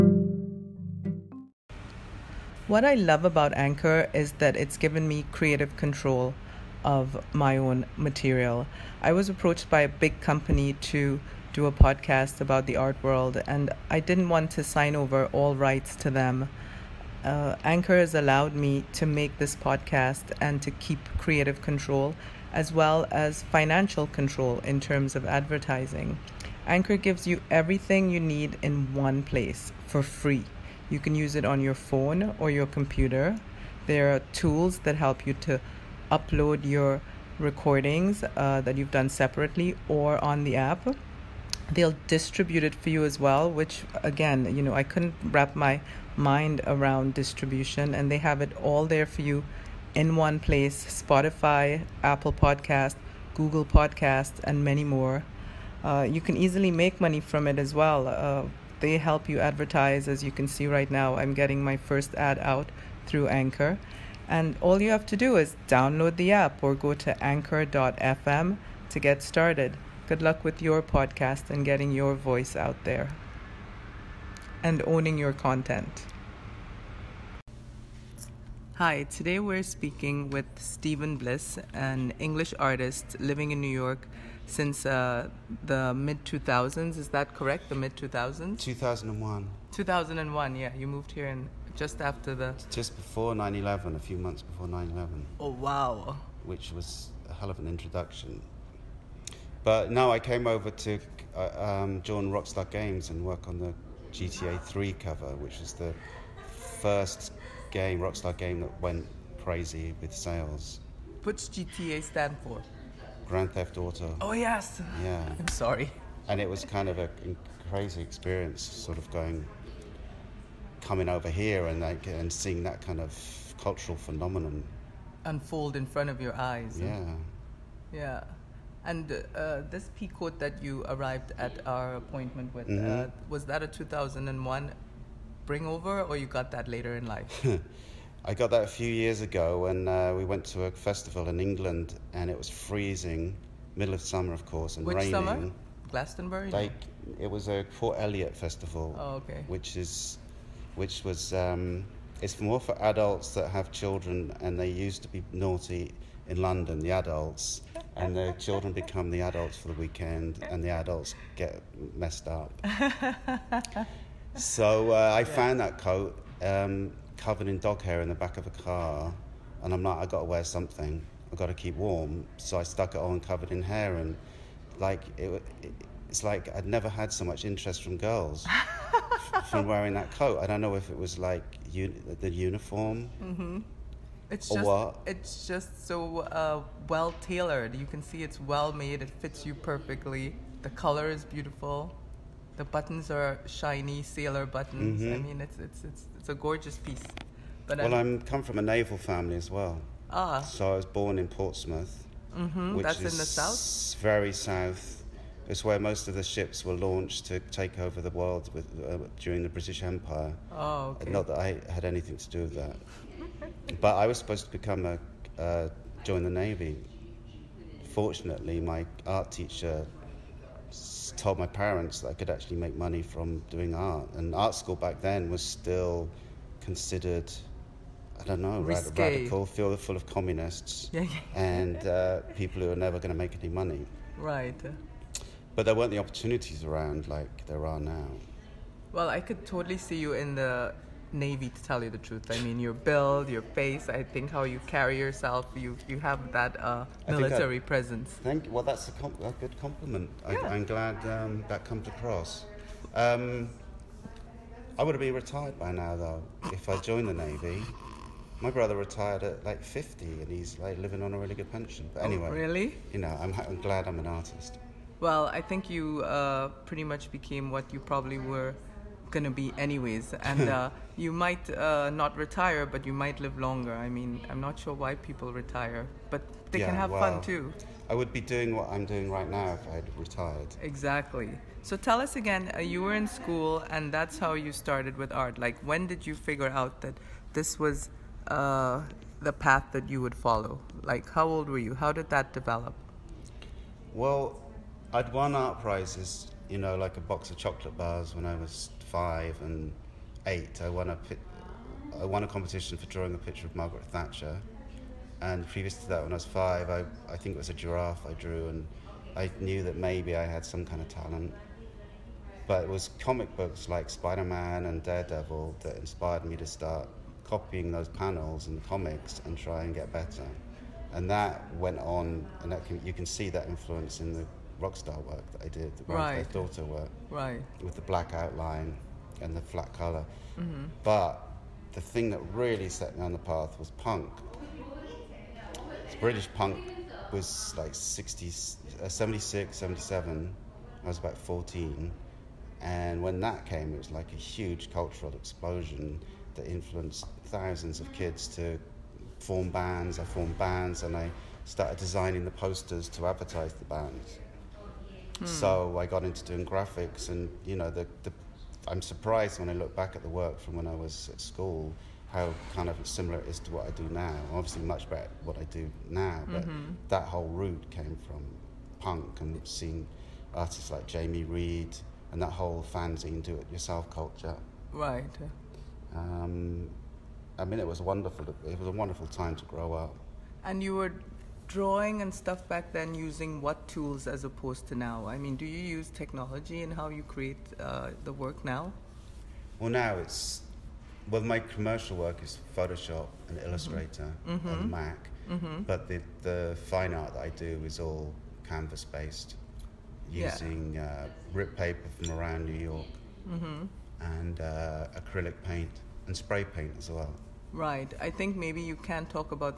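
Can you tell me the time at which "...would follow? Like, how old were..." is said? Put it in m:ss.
4:50.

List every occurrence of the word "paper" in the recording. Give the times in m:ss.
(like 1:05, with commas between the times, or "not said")
6:41.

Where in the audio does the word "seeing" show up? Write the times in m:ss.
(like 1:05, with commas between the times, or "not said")
2:02, 6:09.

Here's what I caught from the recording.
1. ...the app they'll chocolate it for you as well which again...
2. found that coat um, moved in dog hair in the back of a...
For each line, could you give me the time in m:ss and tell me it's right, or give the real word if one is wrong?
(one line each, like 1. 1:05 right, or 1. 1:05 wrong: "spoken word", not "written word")
1. 0:40 wrong: "distribute", not "chocolate"
2. 2:45 wrong: "covered", not "moved".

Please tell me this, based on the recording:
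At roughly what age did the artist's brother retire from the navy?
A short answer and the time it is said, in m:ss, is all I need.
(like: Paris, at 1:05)
50, at 4:19.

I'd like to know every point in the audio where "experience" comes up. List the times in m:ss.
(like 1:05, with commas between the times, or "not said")
1:58.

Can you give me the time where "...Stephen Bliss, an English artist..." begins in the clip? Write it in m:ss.
1:20.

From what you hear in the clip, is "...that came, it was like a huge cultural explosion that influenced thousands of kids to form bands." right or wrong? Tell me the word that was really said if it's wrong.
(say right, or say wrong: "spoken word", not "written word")
right.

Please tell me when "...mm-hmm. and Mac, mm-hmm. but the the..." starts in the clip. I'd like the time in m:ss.
6:34.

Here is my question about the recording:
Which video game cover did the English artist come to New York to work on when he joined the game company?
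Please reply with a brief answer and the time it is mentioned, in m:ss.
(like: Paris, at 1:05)
GTA 3, at 1:44.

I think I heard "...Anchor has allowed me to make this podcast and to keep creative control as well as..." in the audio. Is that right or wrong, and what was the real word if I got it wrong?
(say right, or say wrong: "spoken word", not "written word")
right.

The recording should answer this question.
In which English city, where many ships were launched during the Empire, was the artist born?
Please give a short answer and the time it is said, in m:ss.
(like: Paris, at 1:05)
Portsmouth, at 3:21.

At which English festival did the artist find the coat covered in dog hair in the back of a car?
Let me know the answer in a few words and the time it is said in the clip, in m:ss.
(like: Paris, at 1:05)
Port Eliot festival, at 2:27.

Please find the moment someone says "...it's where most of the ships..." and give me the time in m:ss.
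3:25.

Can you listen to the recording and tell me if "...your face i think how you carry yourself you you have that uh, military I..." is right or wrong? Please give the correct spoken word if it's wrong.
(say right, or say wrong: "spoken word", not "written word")
right.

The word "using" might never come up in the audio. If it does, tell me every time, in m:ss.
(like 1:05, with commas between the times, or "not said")
6:22, 6:40.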